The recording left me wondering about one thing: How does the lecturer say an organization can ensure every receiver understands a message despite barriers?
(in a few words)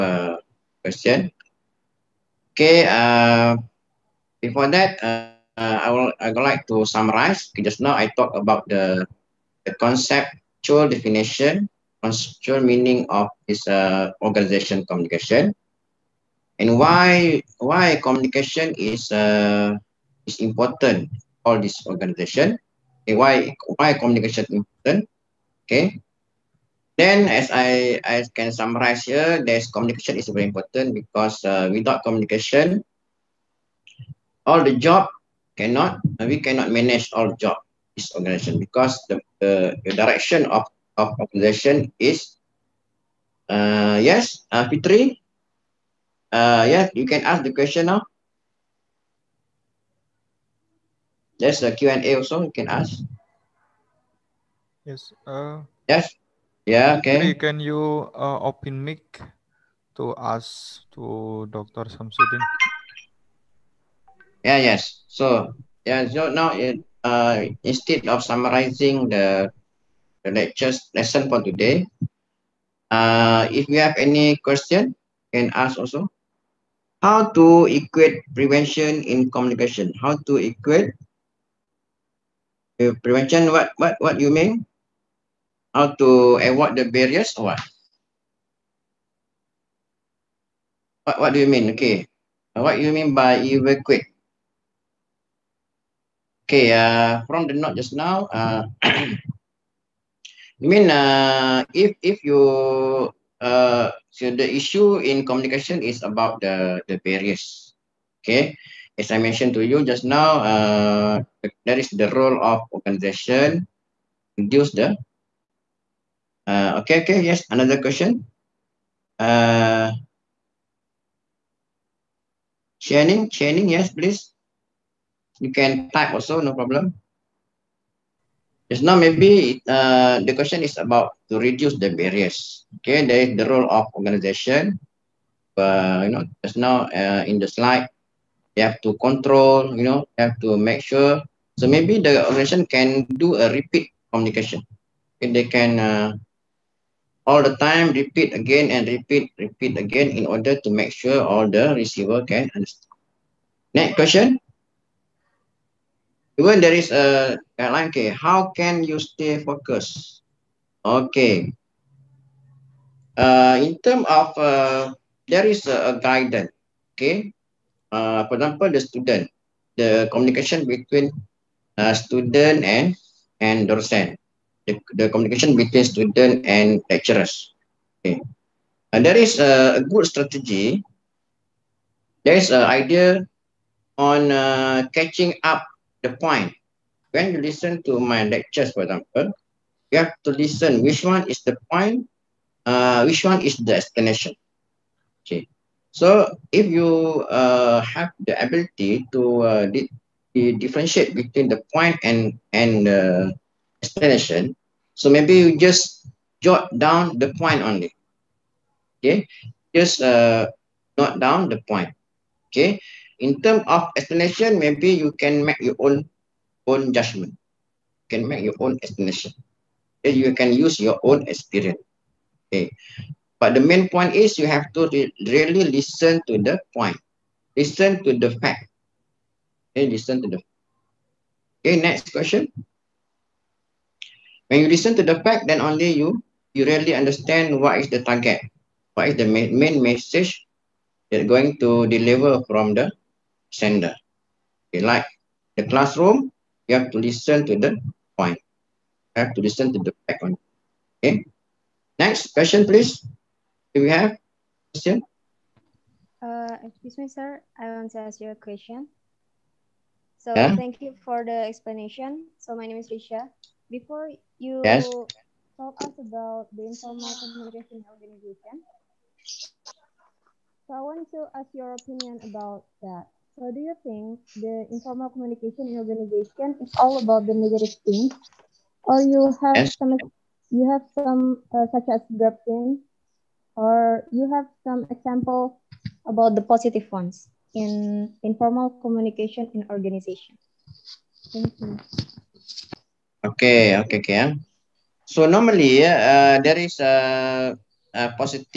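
repeat communication.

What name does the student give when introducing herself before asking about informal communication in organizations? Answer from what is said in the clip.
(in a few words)
Risha.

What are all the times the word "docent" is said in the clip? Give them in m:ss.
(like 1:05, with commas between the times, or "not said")
2:53.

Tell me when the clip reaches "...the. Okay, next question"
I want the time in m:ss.
3:50.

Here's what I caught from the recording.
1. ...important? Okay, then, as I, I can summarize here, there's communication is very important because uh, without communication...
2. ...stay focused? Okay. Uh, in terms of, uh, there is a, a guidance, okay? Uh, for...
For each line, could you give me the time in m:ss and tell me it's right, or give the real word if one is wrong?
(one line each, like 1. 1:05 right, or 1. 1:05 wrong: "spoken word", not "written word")
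1. 0:24 right
2. 2:38 right.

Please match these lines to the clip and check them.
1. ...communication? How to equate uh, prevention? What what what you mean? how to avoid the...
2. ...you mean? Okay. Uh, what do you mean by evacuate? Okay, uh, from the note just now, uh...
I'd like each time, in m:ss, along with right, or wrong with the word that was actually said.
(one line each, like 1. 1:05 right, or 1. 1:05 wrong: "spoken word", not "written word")
1. 1:19 right
2. 1:31 right.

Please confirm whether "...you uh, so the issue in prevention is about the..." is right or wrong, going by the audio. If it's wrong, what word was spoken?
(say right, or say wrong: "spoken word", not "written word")
wrong: "communication", not "prevention".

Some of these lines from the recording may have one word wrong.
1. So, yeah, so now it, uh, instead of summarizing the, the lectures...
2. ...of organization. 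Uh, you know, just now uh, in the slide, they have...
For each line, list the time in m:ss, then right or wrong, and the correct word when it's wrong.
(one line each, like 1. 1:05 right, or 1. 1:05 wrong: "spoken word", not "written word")
1. 1:05 right
2. 2:13 right.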